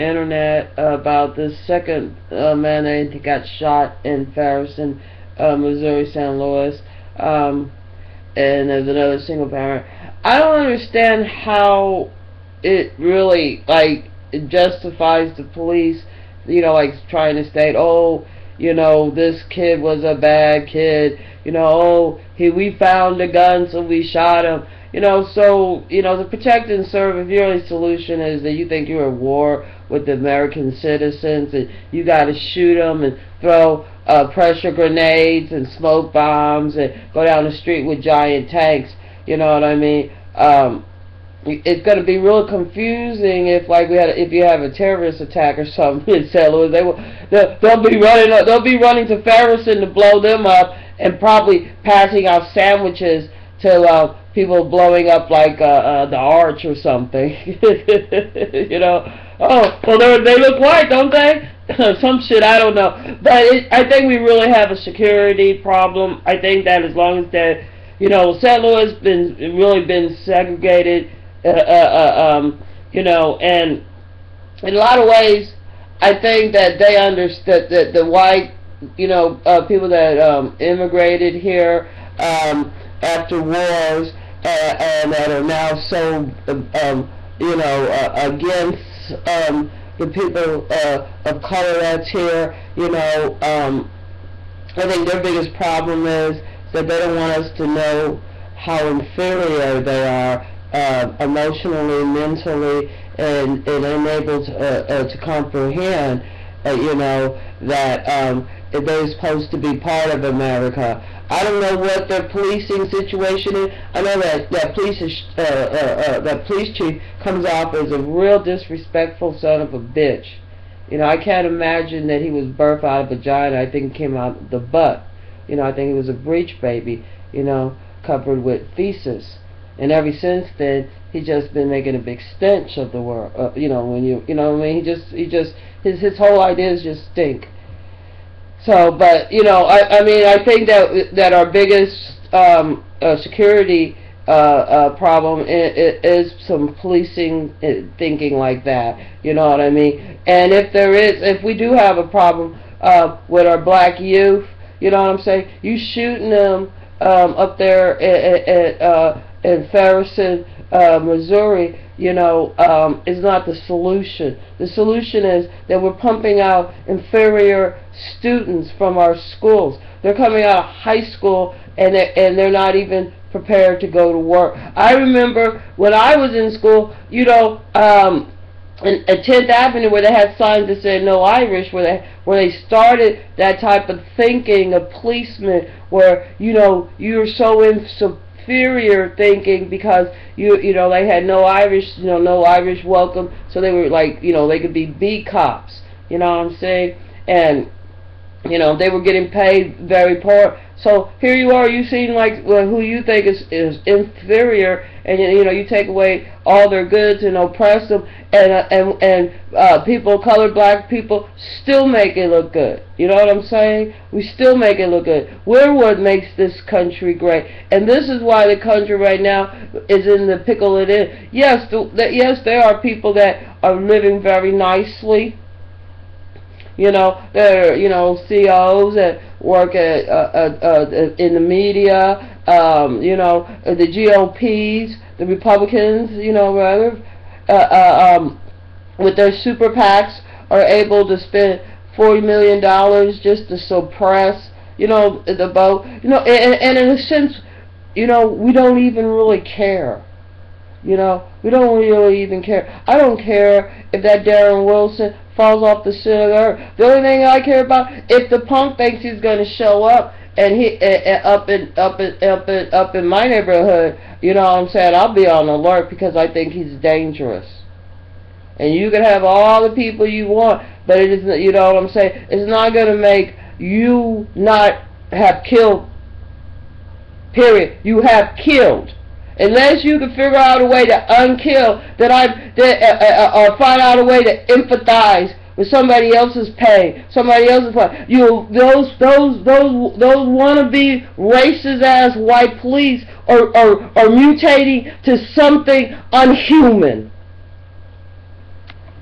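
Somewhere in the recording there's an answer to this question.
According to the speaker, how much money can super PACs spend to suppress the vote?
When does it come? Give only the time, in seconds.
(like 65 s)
241 s.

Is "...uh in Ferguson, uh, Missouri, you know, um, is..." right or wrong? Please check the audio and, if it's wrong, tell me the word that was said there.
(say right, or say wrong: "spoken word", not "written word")
right.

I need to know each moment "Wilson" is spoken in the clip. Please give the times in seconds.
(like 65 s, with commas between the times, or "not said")
254 s.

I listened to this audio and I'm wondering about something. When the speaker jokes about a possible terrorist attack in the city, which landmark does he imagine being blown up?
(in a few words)
the arch.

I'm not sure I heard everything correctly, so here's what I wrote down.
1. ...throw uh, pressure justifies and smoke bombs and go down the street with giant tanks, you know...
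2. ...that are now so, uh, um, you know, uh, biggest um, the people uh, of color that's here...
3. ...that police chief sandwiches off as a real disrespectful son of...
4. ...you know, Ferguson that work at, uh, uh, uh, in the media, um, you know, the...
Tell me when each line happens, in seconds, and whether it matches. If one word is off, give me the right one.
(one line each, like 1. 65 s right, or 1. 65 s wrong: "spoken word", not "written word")
1. 33 s wrong: "grenades", not "justifies"
2. 85 s wrong: "against", not "biggest"
3. 116 s wrong: "comes", not "sandwiches"
4. 227 s wrong: "CEOs", not "Ferguson".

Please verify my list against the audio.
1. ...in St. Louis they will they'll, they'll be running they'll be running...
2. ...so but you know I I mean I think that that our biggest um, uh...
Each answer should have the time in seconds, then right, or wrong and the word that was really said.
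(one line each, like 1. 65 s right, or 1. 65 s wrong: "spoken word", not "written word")
1. 46 s right
2. 138 s right.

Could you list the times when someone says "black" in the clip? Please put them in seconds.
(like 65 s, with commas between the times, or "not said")
153 s, 210 s.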